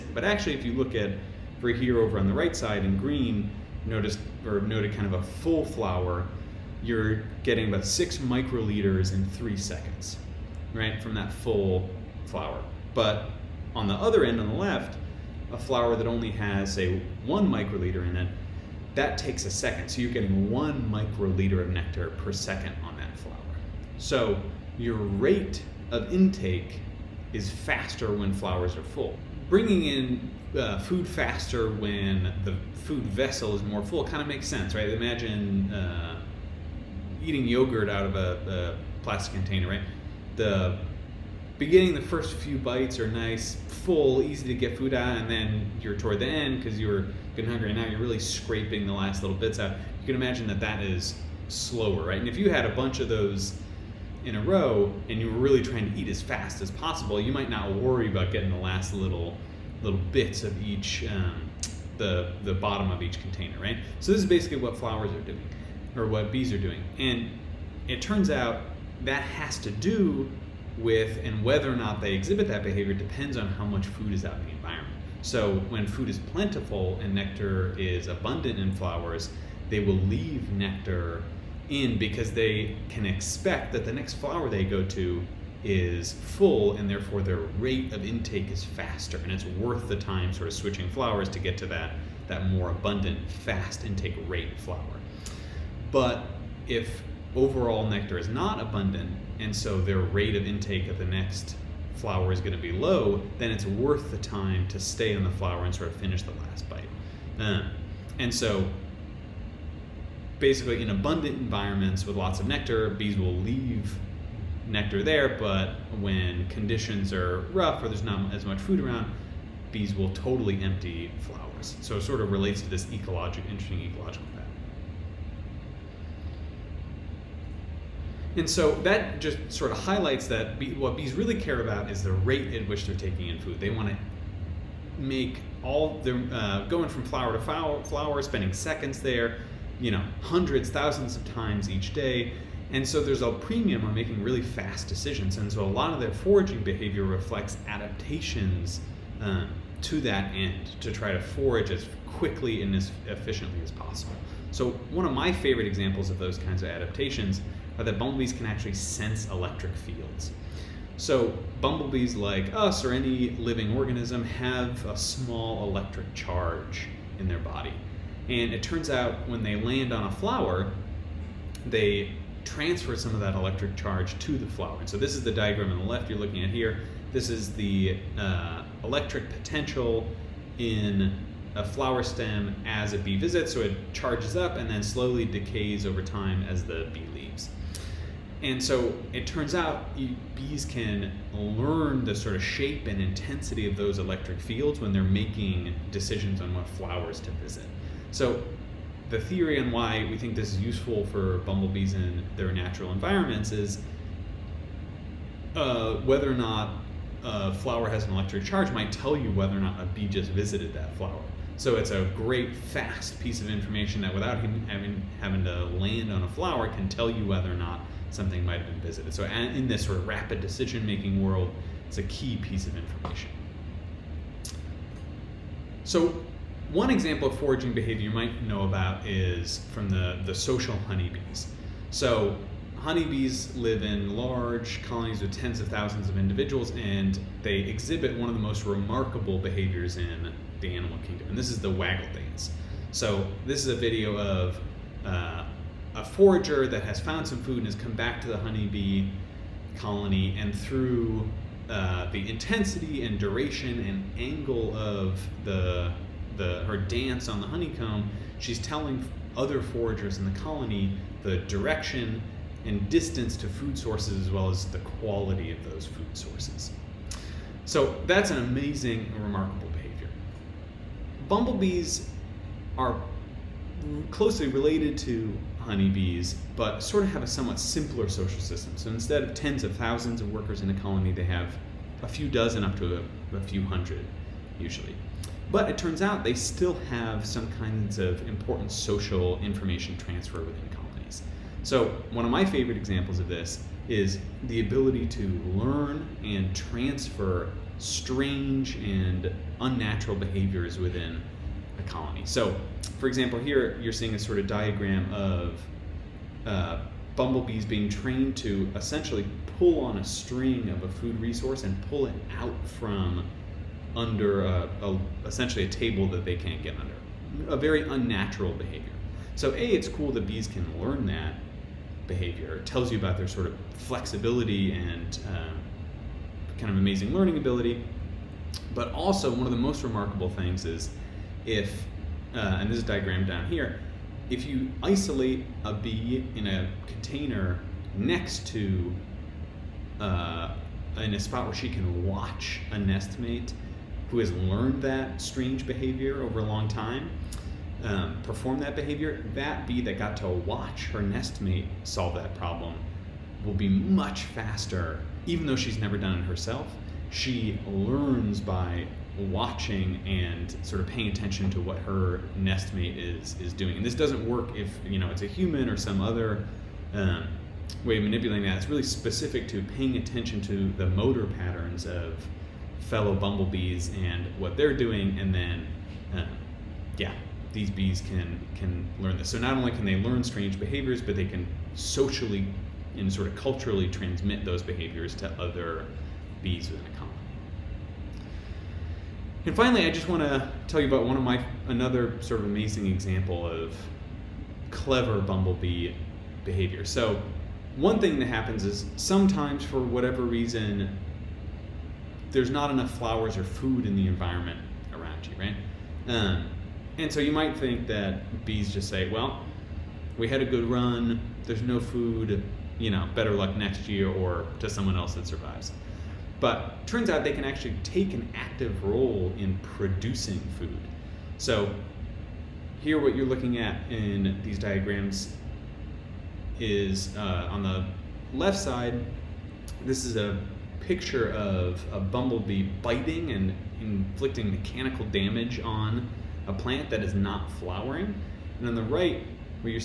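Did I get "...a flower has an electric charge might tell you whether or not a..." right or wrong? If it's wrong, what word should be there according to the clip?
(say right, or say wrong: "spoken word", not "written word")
right.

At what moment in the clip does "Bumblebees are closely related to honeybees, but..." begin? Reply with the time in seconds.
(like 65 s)
271 s.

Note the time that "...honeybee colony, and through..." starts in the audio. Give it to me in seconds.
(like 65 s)
248 s.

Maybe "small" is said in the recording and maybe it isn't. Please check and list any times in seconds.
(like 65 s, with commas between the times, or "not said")
164 s.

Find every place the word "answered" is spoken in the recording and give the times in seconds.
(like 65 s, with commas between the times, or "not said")
not said.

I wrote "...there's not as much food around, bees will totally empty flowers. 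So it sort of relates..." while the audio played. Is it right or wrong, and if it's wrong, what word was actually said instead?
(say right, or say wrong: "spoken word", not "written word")
right.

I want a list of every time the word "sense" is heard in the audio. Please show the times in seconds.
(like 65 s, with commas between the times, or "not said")
34 s, 158 s.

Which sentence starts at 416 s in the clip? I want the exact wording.
But turns out they can actually take an active role in producing food.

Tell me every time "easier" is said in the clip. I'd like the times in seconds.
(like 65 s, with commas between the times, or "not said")
not said.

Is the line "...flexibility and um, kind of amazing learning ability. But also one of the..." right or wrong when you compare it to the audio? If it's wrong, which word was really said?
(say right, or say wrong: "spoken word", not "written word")
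right.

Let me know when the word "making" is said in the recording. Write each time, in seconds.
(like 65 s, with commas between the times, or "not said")
143 s, 195 s, 220 s.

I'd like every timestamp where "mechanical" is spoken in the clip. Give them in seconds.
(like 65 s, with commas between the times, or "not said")
434 s.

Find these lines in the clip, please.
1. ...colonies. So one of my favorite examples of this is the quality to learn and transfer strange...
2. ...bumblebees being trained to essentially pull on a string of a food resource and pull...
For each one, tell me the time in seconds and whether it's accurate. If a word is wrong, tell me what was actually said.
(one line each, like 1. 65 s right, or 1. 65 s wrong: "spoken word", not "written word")
1. 290 s wrong: "ability", not "quality"
2. 307 s right.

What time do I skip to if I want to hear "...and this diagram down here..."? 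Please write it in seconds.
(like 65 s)
332 s.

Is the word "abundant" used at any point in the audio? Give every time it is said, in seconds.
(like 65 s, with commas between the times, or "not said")
78 s, 92 s, 98 s, 110 s.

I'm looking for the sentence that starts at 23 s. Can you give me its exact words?
So your rate of intake is faster when flowers are full.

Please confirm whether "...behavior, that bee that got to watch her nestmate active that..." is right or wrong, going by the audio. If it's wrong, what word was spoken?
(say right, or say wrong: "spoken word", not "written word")
wrong: "solve", not "active".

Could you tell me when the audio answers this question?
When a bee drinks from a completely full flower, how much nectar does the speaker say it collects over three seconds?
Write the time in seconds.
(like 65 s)
7 s.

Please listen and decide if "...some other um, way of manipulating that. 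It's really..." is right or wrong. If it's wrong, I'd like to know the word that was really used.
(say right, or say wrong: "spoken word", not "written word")
right.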